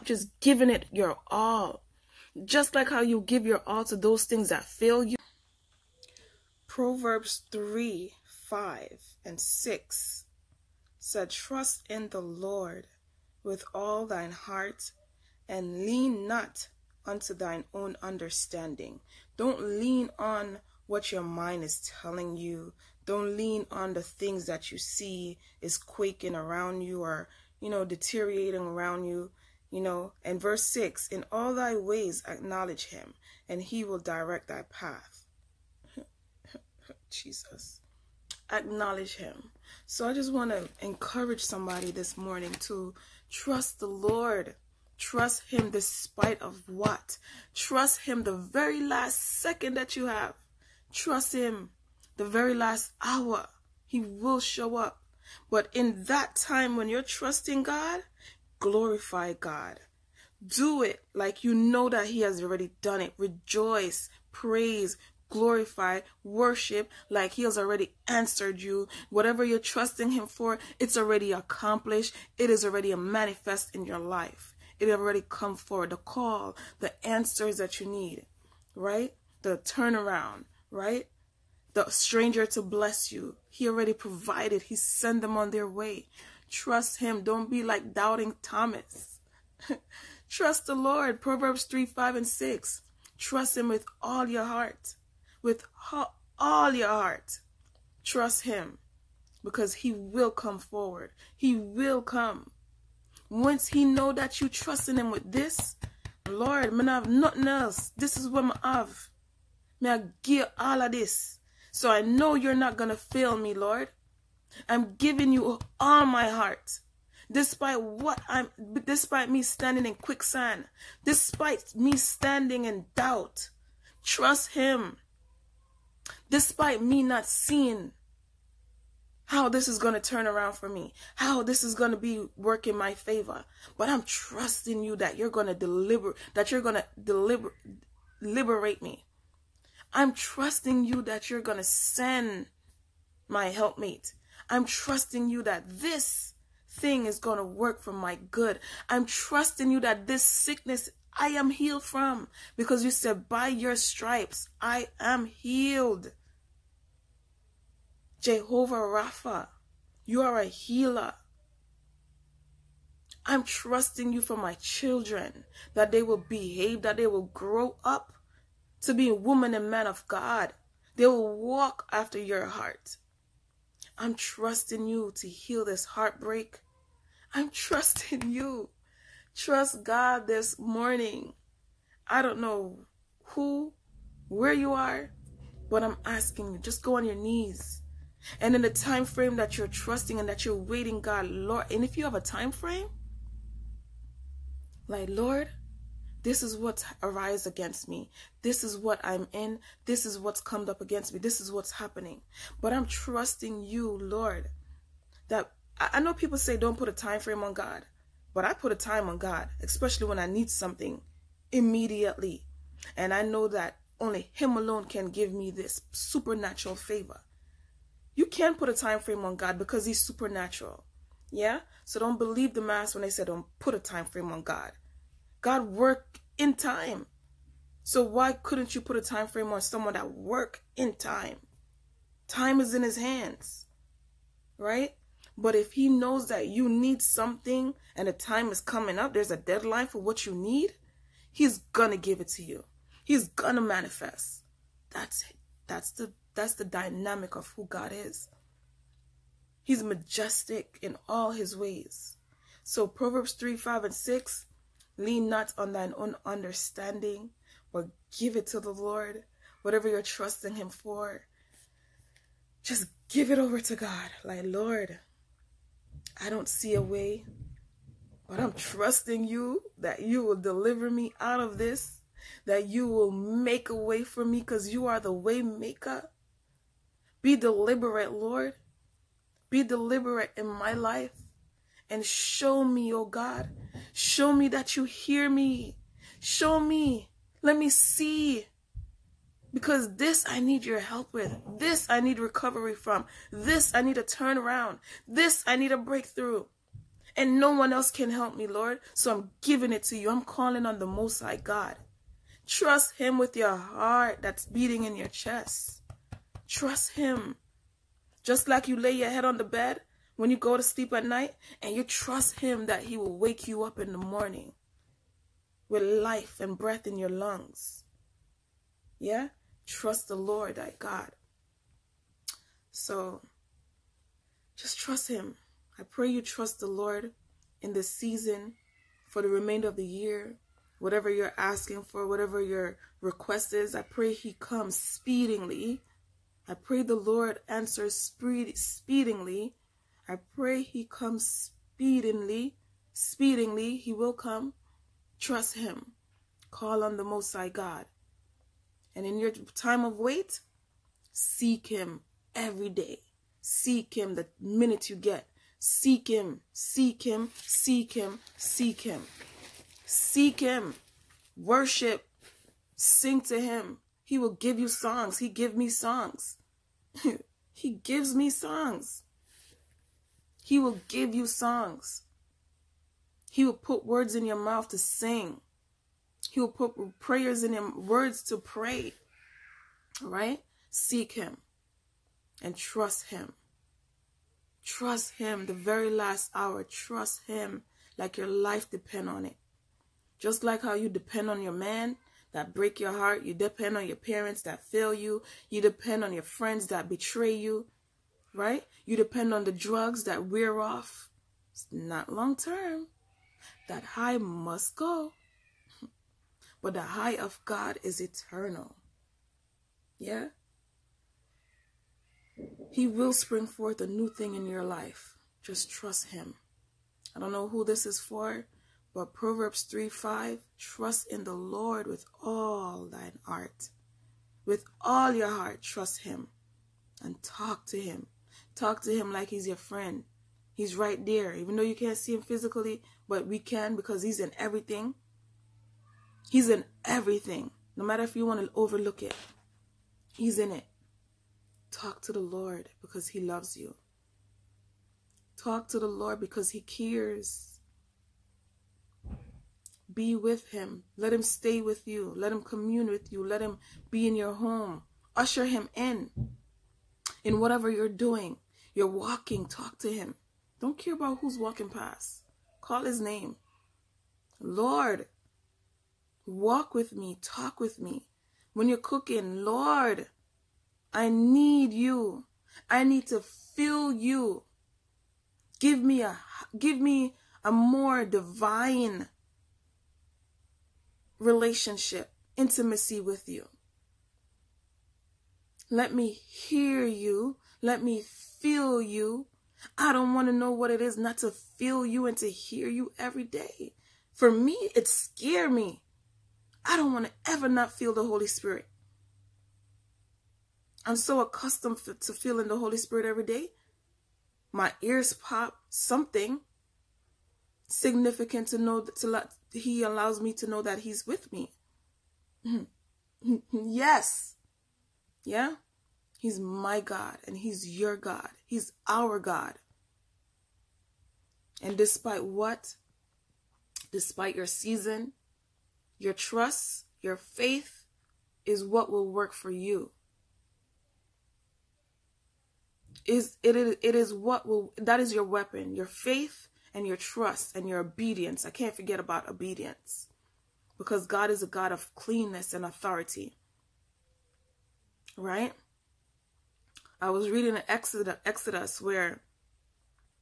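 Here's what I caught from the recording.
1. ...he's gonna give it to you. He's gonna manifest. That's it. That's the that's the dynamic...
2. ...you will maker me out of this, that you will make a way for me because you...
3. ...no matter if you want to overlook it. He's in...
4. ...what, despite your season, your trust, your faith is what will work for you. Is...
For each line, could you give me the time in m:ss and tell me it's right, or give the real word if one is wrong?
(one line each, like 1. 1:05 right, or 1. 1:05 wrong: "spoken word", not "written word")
1. 4:01 right
2. 4:30 wrong: "deliver", not "maker"
3. 7:17 right
4. 8:42 right.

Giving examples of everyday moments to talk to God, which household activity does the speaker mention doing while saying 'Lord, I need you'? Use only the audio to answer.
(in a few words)
Cooking.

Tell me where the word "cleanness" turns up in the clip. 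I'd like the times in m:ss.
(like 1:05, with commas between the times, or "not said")
9:01.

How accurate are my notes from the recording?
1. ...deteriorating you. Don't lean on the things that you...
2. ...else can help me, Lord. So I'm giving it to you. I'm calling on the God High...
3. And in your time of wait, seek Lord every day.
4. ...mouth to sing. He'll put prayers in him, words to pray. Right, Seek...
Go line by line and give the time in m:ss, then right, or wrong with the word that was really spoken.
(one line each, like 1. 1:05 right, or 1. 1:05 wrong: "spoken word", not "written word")
1. 0:22 wrong: "telling", not "deteriorating"
2. 4:57 wrong: "Most", not "God"
3. 5:48 wrong: "Him", not "Lord"
4. 6:14 right.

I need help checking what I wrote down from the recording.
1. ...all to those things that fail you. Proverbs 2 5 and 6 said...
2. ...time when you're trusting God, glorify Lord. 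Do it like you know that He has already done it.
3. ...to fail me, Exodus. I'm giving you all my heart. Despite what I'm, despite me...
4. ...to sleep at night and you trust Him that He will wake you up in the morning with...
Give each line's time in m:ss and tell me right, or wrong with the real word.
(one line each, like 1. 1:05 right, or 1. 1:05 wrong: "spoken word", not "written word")
1. 0:03 wrong: "3", not "2"
2. 0:56 wrong: "God", not "Lord"
3. 1:52 wrong: "Lord", not "Exodus"
4. 5:10 right.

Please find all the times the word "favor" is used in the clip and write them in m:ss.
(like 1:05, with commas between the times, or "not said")
2:12, 3:36.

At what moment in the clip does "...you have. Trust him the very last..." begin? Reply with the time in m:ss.
0:49.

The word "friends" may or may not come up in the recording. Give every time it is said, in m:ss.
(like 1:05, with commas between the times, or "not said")
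6:36, 7:09.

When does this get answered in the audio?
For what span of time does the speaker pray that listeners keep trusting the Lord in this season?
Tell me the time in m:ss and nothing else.
5:29.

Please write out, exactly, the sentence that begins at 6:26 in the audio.
Trust him like your life depend on it.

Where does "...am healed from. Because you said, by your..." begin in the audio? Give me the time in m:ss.
2:31.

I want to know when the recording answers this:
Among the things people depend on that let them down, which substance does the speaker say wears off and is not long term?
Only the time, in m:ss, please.
6:39.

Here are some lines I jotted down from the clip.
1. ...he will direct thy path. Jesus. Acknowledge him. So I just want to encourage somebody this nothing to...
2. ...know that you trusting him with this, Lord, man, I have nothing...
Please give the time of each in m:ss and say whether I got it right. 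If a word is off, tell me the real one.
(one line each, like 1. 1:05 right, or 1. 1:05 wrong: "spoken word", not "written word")
1. 0:33 wrong: "morning", not "nothing"
2. 1:43 right.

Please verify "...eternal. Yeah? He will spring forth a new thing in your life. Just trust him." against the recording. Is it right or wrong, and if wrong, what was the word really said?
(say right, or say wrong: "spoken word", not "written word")
right.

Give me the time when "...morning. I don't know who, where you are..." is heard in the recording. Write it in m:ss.
3:00.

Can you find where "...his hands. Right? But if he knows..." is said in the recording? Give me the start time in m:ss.
3:52.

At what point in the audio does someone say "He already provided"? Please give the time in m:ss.
1:23.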